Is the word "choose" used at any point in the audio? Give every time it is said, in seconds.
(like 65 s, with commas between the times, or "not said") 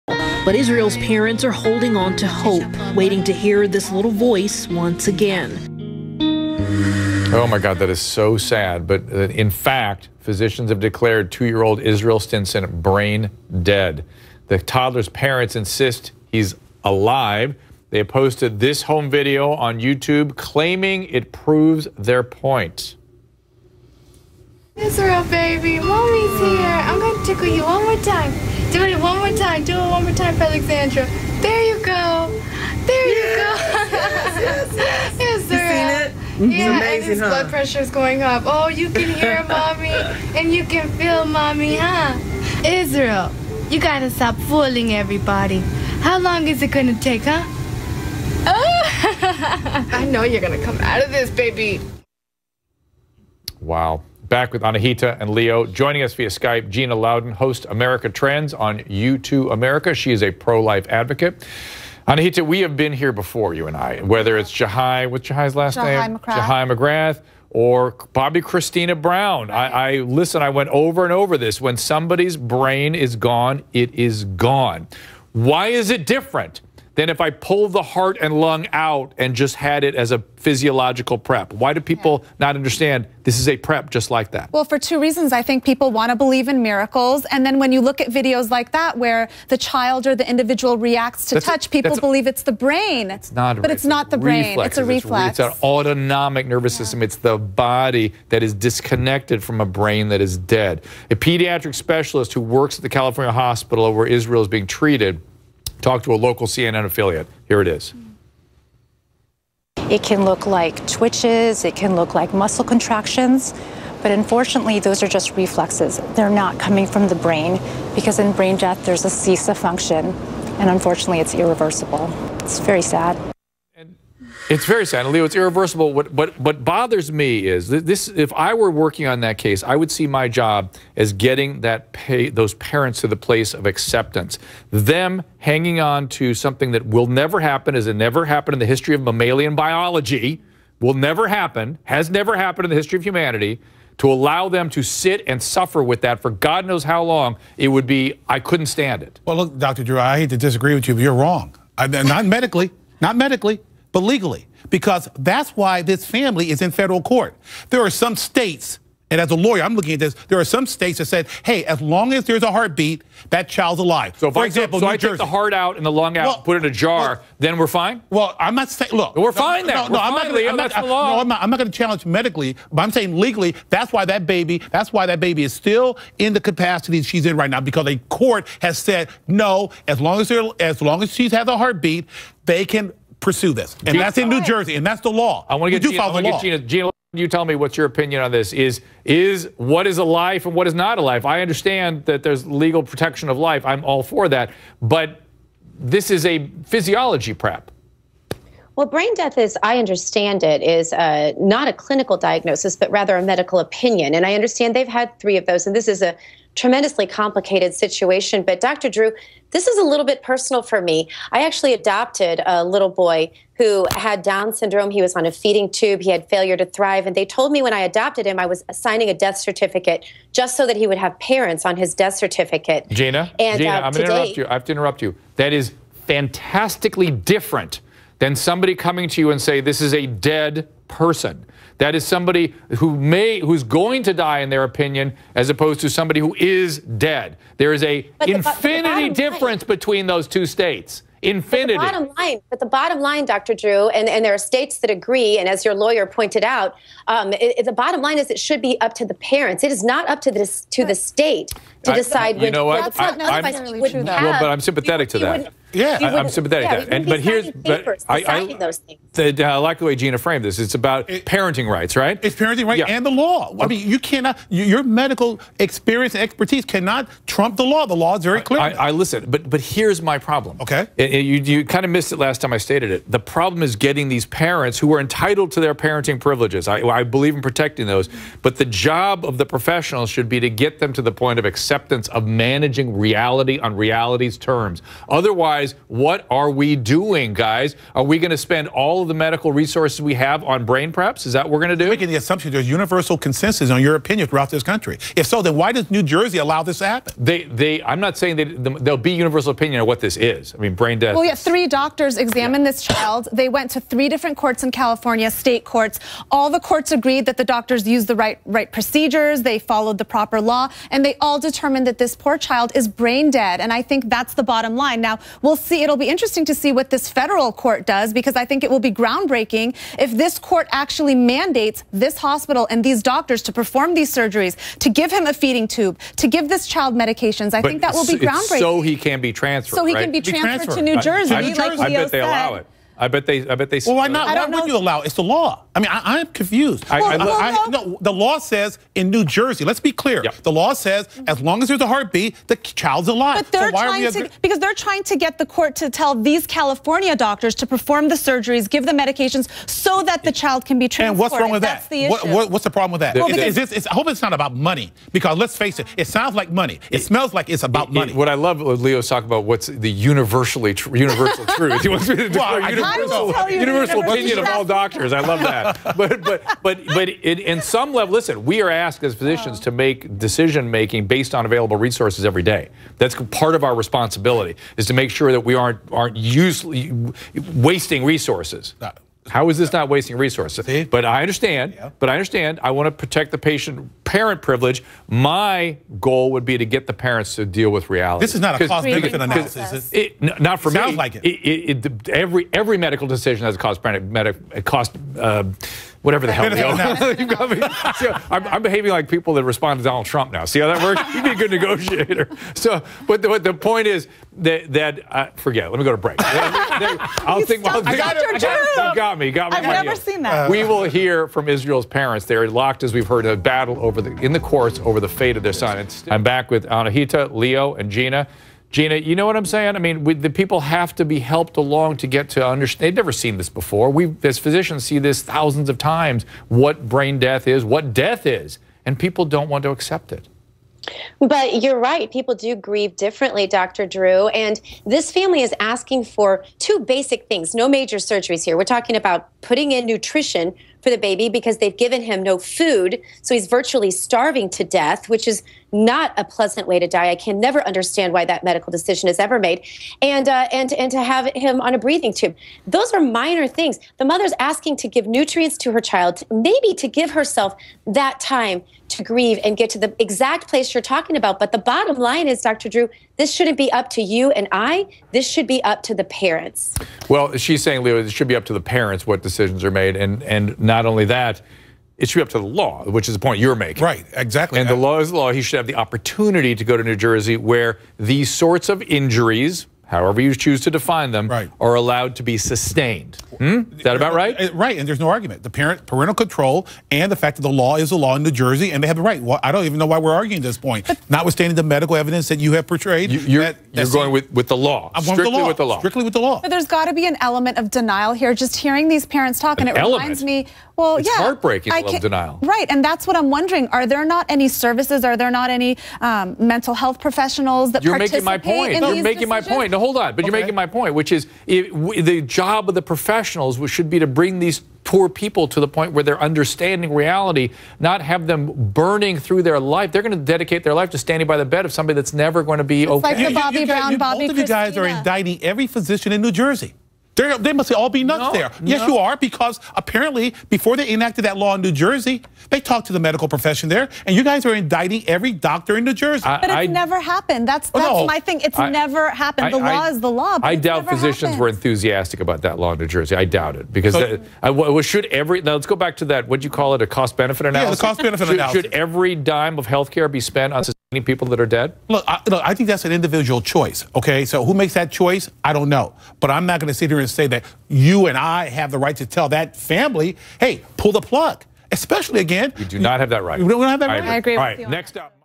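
480 s.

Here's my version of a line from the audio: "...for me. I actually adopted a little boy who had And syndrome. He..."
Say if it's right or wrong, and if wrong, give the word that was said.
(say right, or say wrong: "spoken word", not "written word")
wrong: "Down", not "And".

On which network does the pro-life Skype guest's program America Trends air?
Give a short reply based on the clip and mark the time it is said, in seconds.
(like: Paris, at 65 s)
YouToo America, at 58 s.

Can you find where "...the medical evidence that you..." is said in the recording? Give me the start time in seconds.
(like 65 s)
491 s.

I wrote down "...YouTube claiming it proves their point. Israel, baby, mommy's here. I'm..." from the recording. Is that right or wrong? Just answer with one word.
right.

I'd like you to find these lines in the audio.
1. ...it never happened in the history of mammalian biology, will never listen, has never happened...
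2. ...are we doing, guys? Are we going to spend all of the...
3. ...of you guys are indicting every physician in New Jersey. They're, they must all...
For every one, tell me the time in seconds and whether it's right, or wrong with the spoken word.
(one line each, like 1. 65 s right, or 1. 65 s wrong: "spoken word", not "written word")
1. 137 s wrong: "happen", not "listen"
2. 286 s right
3. 524 s right.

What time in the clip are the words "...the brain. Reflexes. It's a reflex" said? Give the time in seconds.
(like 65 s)
94 s.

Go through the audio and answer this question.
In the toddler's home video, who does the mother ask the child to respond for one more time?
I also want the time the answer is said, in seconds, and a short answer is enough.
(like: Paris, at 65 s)
Alexandra, at 30 s.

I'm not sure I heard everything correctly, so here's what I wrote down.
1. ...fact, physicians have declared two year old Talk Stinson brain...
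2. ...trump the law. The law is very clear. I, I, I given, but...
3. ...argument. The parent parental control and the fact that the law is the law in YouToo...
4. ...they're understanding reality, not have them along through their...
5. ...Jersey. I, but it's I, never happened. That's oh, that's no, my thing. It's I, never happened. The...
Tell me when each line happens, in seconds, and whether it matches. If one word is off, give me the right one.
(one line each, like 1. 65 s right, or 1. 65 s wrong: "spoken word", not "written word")
1. 9 s wrong: "Israel", not "Talk"
2. 267 s wrong: "listen", not "given"
3. 485 s wrong: "New", not "YouToo"
4. 516 s wrong: "burning", not "along"
5. 535 s right.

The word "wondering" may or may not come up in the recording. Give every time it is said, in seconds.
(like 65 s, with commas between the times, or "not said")
503 s.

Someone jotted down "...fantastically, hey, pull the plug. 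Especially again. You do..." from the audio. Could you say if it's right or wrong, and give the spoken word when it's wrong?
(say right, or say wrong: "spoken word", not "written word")
wrong: "family", not "fantastically".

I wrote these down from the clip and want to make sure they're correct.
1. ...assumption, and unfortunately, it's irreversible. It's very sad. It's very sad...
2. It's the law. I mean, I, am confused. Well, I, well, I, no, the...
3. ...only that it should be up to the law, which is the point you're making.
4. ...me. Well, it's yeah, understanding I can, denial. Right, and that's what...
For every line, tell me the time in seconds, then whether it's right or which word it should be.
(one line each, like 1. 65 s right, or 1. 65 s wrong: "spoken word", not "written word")
1. 119 s wrong: "function", not "assumption"
2. 335 s right
3. 470 s right
4. 500 s wrong: "heartbreaking", not "understanding".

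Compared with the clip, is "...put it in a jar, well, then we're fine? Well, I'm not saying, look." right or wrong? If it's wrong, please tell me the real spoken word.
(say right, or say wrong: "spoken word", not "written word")
right.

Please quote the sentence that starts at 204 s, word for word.
And I understand they've had three of those.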